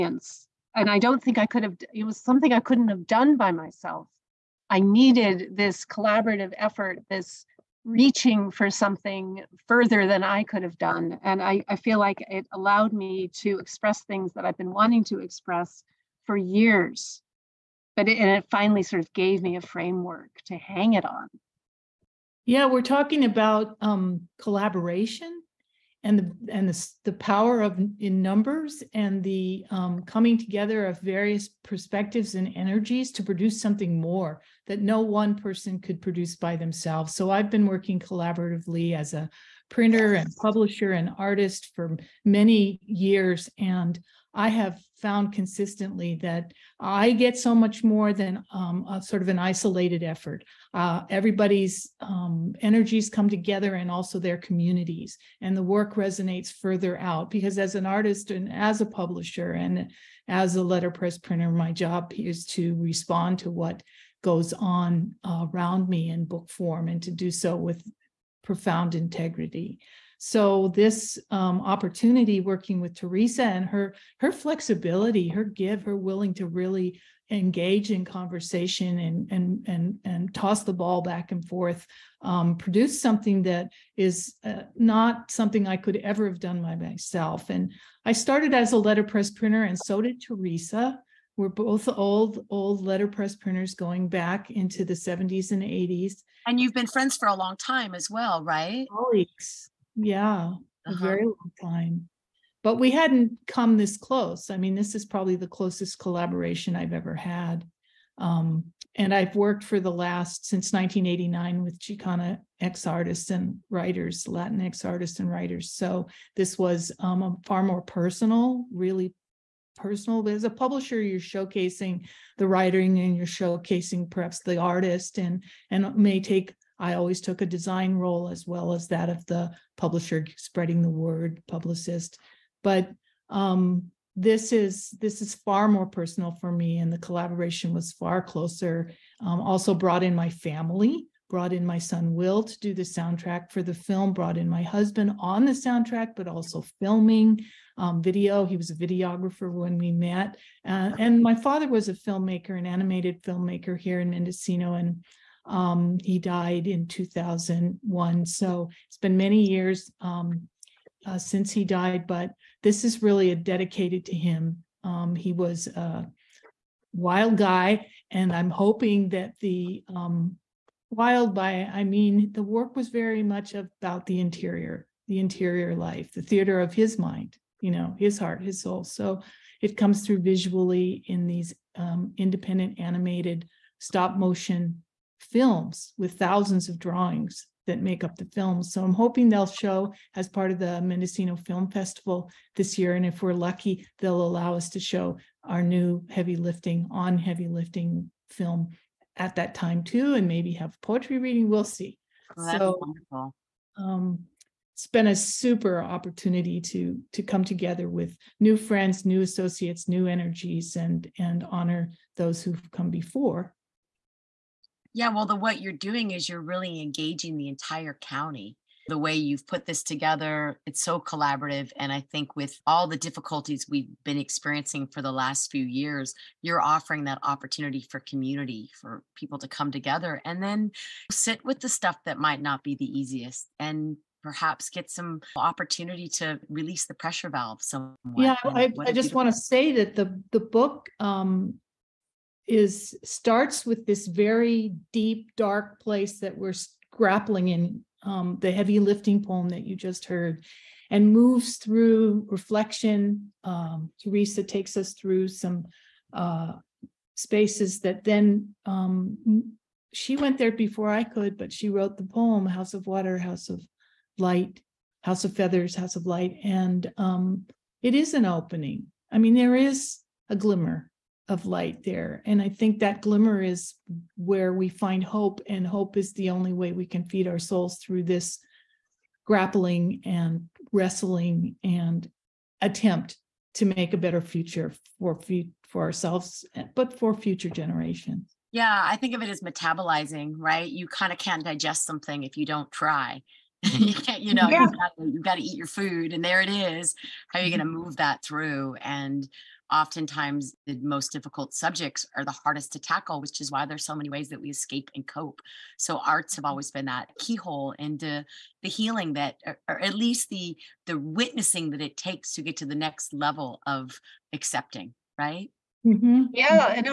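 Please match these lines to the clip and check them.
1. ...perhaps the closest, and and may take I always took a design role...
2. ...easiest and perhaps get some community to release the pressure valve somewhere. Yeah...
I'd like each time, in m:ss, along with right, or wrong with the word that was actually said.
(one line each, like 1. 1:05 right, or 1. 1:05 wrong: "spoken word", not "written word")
1. 2:04 wrong: "artist", not "closest"
2. 3:52 wrong: "opportunity", not "community".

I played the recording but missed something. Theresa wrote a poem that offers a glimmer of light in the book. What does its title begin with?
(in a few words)
House of Water.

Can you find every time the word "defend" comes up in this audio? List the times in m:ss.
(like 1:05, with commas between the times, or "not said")
not said.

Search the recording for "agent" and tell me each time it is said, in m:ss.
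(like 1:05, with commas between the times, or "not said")
not said.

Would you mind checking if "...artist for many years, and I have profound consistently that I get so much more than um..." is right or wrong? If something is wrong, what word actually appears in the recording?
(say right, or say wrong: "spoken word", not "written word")
wrong: "found", not "profound".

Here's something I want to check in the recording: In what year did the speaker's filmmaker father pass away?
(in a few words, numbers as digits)
2001.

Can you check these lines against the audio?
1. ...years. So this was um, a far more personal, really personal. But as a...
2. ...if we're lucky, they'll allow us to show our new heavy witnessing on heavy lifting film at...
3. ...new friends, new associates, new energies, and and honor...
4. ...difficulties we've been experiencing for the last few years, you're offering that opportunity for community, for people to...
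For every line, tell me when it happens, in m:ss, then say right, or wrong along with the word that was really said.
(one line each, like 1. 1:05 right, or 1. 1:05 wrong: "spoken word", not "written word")
1. 1:55 wrong: "writers", not "years"
2. 3:13 wrong: "lifting", not "witnessing"
3. 3:28 right
4. 3:42 right.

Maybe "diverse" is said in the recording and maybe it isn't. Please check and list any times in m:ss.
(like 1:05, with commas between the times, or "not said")
not said.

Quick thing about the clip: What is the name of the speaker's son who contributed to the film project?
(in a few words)
Will.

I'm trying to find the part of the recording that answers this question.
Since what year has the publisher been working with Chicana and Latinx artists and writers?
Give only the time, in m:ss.
1:50.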